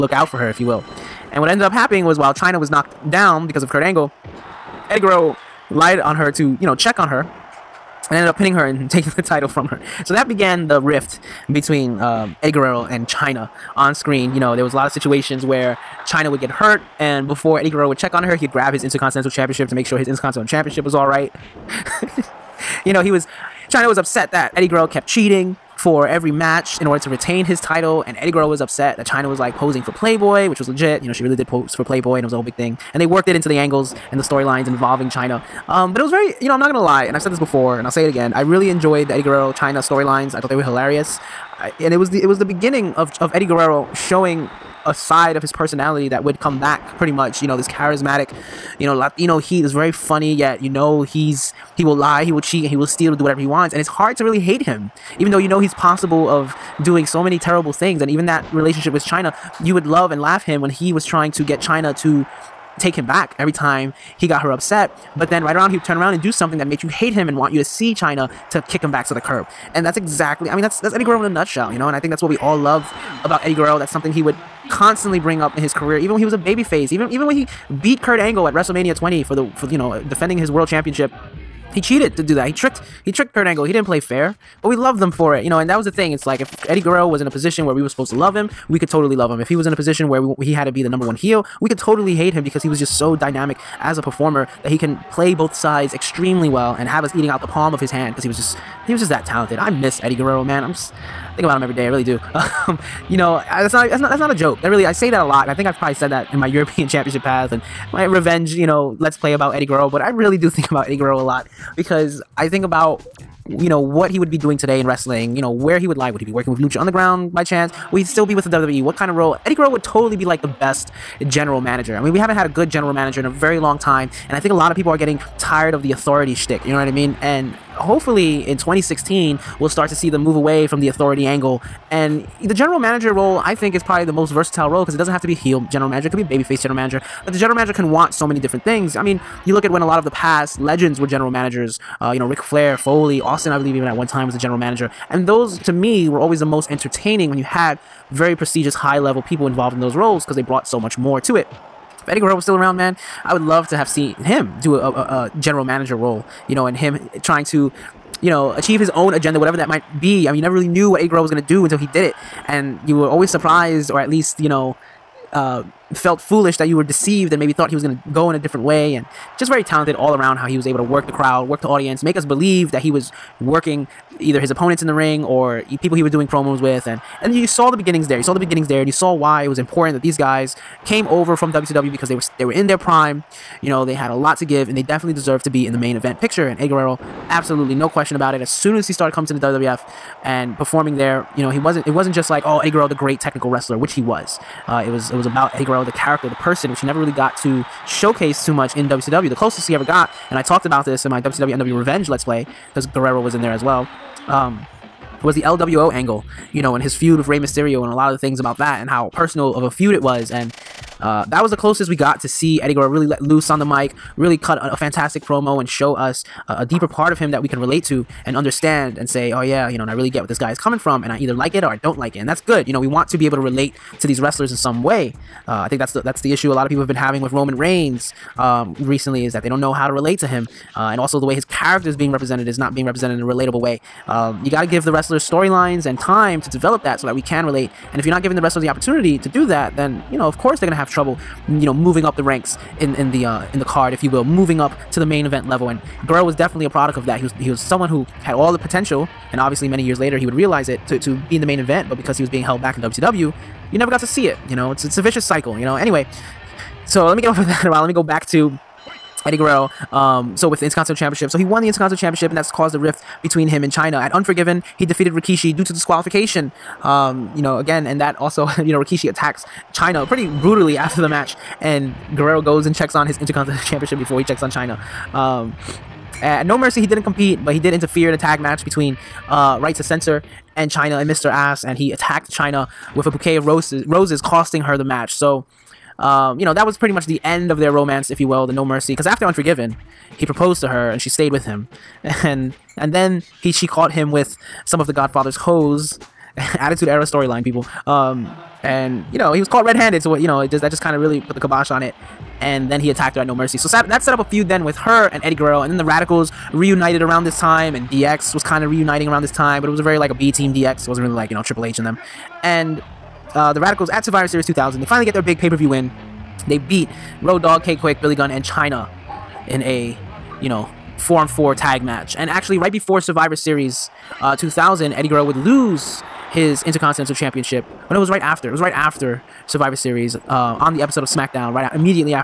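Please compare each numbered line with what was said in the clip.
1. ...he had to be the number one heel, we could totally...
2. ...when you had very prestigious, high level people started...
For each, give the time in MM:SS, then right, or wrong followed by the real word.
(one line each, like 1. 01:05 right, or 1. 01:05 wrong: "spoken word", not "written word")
1. 01:30 right
2. 02:27 wrong: "involved", not "started".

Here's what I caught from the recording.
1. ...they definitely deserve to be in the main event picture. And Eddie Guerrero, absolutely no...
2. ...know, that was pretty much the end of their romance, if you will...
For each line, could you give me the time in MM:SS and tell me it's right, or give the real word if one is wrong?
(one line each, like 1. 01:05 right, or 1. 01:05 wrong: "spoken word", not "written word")
1. 03:04 right
2. 04:46 right.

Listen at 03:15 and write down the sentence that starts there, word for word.
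It was about Eddie Guerrero, the character, the person, which he never really got to showcase too much in WCW.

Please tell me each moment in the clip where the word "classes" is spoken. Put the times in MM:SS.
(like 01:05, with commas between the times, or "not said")
not said.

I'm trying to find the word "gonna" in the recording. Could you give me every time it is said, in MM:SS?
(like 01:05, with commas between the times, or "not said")
00:36, 02:41, 04:00.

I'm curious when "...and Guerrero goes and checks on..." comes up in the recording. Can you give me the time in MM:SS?
04:31.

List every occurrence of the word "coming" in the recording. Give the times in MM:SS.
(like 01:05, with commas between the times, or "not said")
03:09, 03:40.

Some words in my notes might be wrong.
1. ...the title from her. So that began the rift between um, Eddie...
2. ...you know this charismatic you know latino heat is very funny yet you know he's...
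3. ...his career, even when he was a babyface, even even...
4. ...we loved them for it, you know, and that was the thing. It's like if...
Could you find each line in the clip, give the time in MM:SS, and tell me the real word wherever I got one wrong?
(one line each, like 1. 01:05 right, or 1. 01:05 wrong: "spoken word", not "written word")
1. 00:09 right
2. 00:47 right
3. 01:15 right
4. 01:24 right.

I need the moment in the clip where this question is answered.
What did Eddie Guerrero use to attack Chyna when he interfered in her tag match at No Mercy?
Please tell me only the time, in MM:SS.
04:43.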